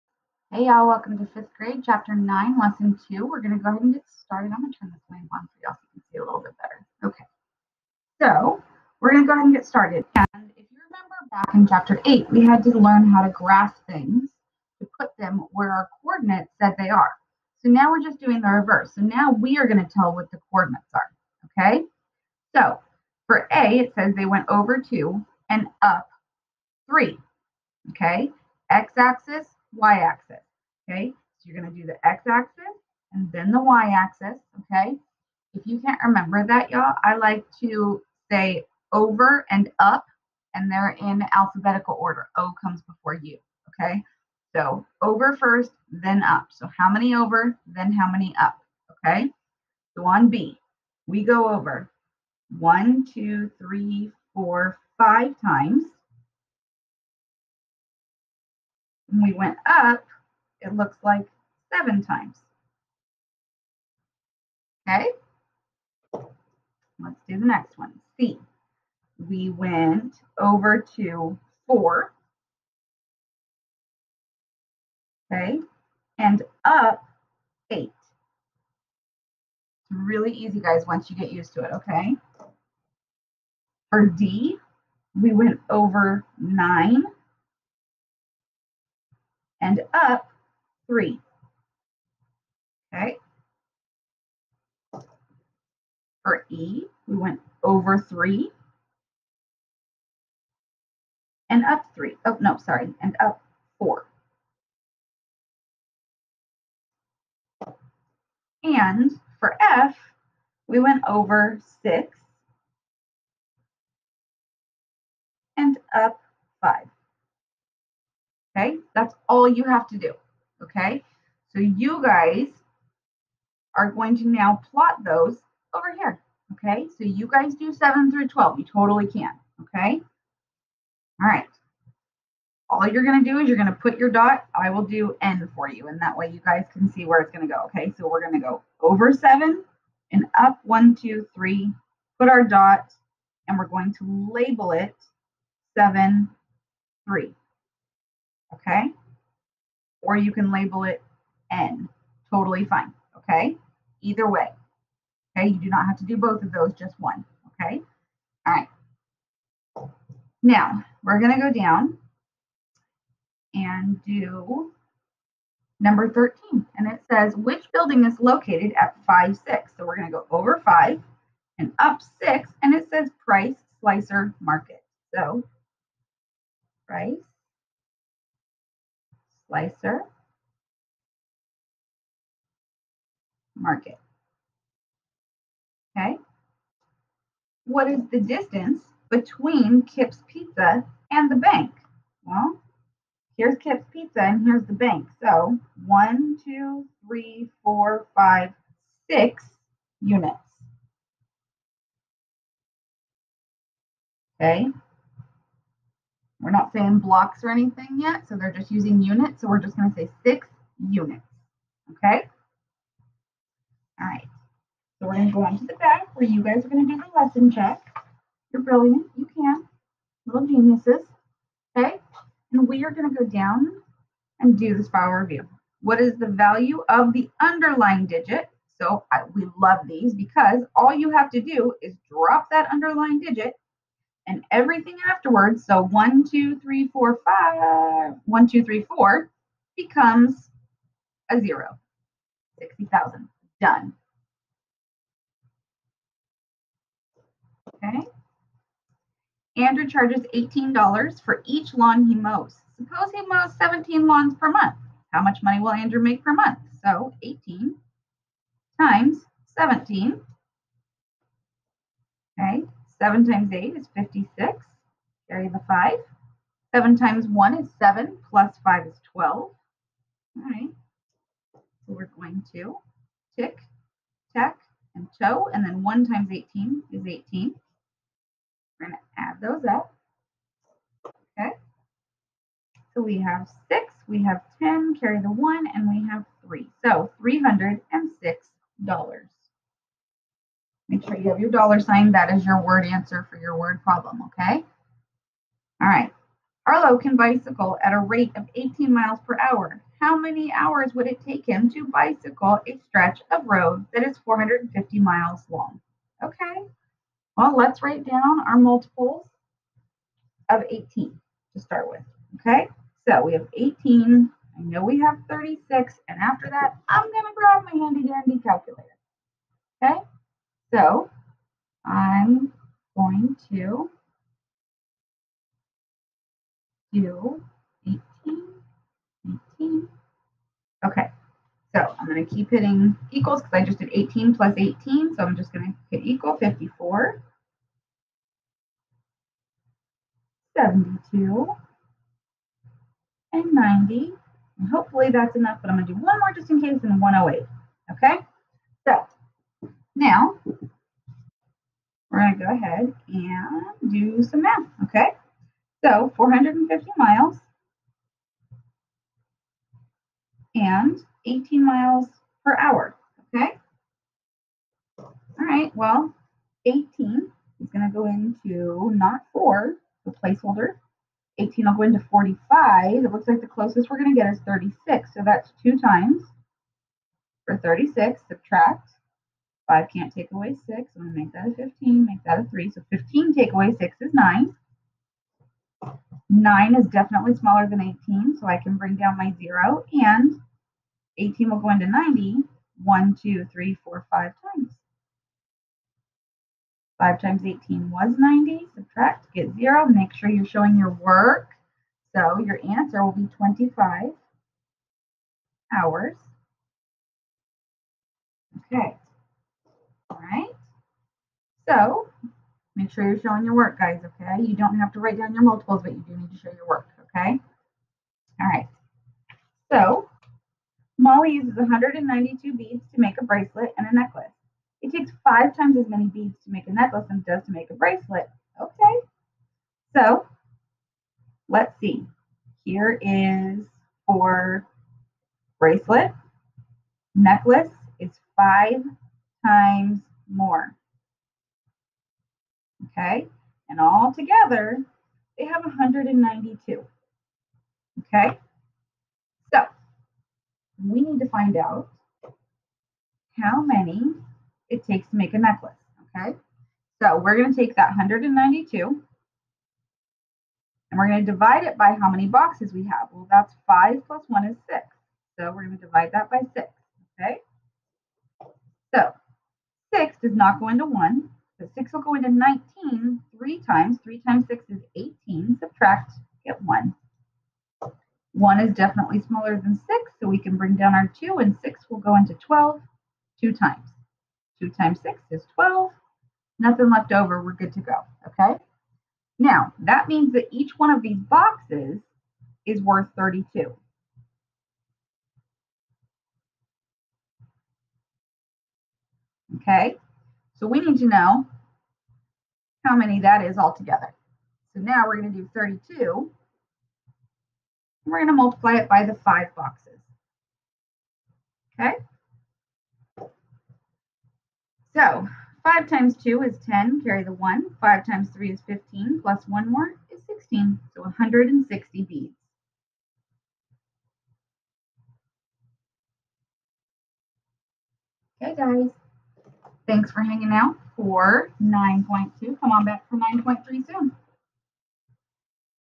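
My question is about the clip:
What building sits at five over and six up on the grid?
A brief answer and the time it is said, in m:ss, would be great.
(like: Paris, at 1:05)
Price Slicer Market, at 2:53.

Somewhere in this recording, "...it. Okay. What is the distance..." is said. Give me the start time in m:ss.
3:03.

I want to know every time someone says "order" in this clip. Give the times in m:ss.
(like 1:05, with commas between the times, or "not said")
0:41.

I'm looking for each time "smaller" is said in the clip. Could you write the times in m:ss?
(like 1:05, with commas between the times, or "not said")
6:27, 7:59.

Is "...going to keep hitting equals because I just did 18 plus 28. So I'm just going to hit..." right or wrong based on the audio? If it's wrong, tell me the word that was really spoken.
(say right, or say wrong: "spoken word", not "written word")
wrong: "18", not "28".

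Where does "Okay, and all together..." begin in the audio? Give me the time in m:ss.
7:22.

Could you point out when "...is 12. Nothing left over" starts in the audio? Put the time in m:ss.
8:05.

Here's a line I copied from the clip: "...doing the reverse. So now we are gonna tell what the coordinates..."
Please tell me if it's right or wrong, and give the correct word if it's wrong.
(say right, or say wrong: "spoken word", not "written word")
right.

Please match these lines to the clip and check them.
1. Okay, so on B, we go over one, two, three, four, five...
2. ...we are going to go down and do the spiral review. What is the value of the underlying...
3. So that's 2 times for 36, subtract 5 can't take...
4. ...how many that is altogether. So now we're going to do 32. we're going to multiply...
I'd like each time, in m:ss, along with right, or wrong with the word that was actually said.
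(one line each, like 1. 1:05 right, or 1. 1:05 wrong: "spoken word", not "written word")
1. 0:49 right
2. 3:42 right
3. 6:15 right
4. 8:22 right.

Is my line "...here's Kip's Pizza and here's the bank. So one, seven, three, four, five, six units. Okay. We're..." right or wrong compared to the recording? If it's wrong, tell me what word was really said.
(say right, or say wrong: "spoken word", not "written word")
wrong: "two", not "seven".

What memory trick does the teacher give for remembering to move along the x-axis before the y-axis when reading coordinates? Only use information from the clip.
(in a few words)
over and up.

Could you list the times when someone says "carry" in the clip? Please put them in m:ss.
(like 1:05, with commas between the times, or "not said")
4:25, 4:44, 8:37.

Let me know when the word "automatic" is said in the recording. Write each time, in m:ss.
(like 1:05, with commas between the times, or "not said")
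not said.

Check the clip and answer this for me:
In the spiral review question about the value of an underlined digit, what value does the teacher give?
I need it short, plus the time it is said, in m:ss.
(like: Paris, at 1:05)
60,000, at 4:02.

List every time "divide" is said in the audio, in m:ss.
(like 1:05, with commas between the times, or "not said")
7:41, 7:45.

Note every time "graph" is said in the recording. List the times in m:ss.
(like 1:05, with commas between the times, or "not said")
0:13.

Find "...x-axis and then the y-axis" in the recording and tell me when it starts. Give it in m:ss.
0:32.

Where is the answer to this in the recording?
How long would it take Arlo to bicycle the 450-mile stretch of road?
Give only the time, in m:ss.
6:43.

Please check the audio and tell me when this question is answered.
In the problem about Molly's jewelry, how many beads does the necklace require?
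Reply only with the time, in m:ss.
8:41.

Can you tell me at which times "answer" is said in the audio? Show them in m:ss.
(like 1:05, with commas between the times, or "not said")
4:52, 6:42.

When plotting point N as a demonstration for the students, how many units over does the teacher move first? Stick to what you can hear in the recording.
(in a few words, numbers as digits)
7.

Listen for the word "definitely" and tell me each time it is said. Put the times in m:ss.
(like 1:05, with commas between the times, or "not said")
6:26, 7:58.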